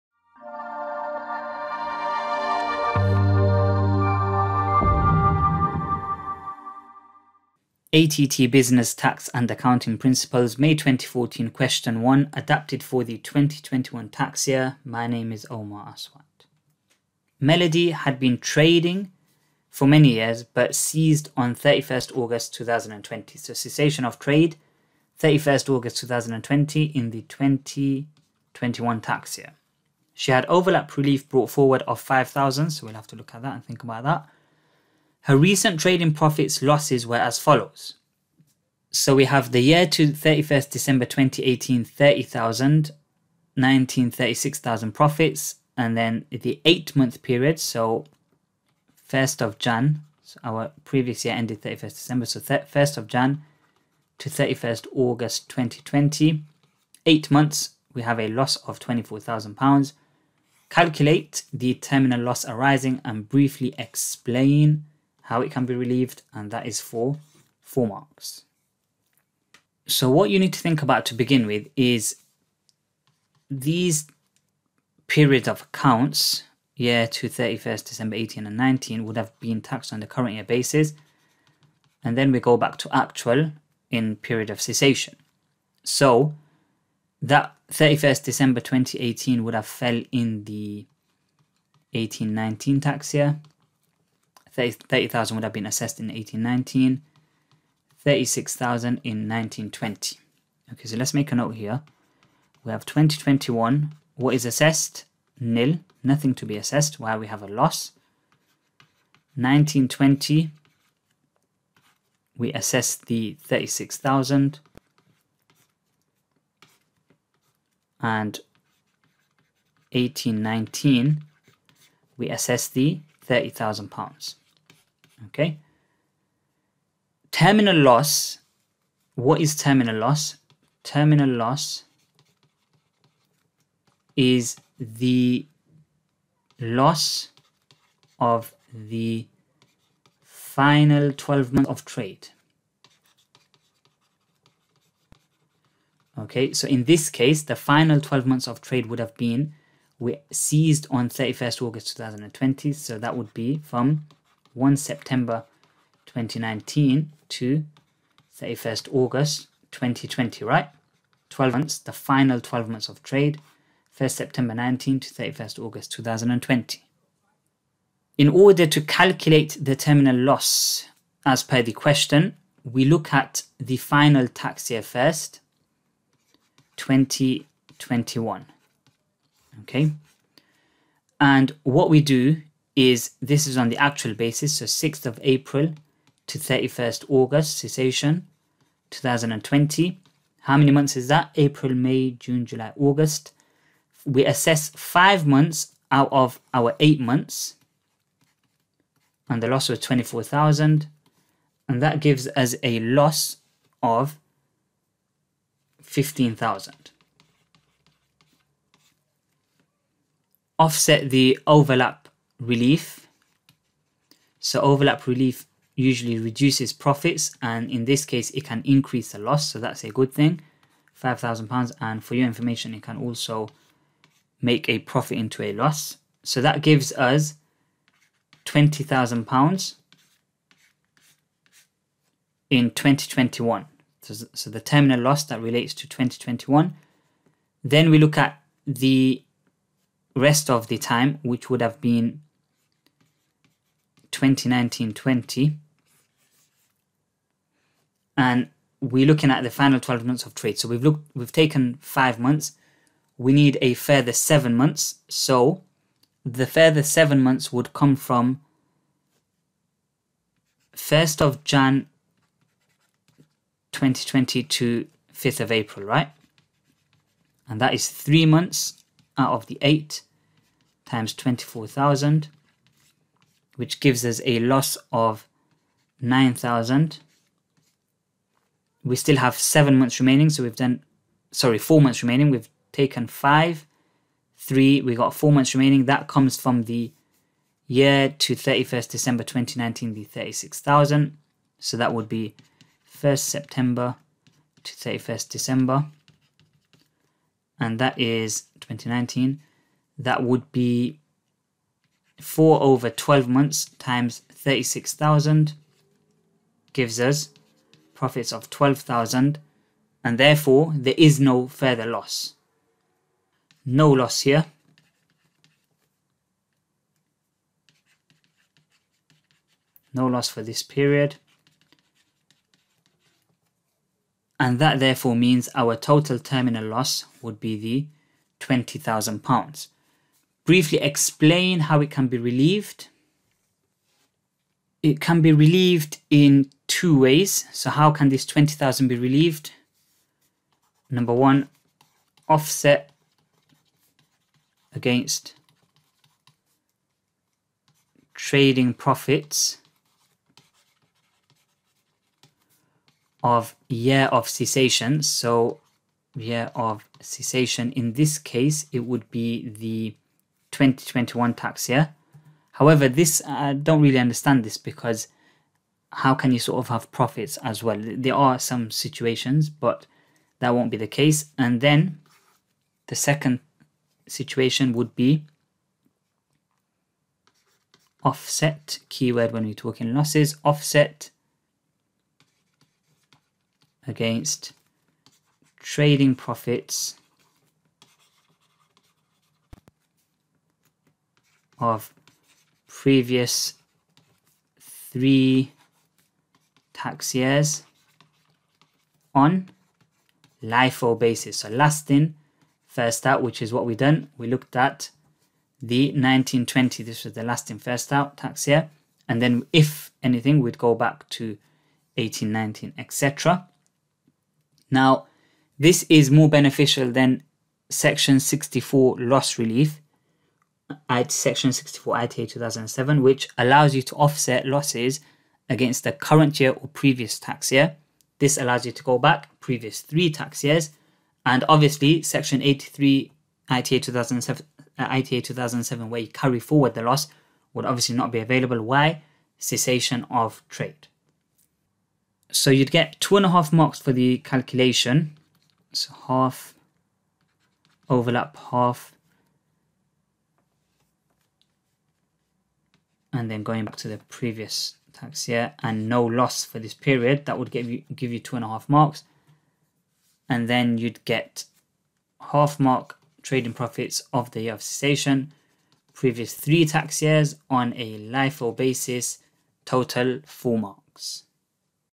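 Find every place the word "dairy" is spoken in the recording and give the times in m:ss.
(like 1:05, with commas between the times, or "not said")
not said.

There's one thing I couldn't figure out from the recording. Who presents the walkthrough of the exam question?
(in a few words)
Omar Aswat.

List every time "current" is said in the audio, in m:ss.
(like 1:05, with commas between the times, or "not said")
1:20, 7:05.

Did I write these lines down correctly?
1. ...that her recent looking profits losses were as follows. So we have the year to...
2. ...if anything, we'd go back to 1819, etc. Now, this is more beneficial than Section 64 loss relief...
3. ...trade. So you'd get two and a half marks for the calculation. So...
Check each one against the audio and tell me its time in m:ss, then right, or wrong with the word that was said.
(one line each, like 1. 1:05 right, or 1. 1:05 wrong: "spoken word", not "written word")
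1. 0:34 wrong: "trading", not "looking"
2. 6:49 right
3. 7:20 right.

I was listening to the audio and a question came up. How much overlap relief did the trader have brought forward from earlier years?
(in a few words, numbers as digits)
5,000.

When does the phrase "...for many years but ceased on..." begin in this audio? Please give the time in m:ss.
0:19.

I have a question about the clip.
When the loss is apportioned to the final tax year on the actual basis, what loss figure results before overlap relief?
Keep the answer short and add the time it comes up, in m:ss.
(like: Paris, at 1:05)
15,000, at 3:22.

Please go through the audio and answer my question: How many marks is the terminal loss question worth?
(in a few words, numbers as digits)
4.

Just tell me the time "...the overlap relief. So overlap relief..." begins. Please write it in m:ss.
3:31.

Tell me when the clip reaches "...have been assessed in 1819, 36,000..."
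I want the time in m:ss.
1:35.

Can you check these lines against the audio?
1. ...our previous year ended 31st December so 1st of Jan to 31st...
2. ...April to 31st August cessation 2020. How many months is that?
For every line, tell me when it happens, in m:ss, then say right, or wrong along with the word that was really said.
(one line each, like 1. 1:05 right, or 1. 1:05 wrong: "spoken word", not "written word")
1. 0:50 right
2. 3:05 right.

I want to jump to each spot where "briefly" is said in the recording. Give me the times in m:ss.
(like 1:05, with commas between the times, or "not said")
1:03, 5:30.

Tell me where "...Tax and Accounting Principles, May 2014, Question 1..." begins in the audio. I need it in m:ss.
0:08.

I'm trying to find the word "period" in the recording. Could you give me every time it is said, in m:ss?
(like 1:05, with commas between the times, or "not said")
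0:47, 1:15, 1:24, 5:20, 7:36.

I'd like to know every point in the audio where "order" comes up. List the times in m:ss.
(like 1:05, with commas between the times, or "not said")
2:48.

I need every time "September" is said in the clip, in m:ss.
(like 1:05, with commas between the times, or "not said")
2:34, 2:44, 4:53.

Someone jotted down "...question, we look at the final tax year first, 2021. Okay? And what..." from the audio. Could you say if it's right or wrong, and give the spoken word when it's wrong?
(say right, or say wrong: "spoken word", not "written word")
right.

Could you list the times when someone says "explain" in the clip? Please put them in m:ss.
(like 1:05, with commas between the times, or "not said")
1:03, 5:30.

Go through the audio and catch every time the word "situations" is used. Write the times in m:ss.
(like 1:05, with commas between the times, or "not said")
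6:08, 6:14.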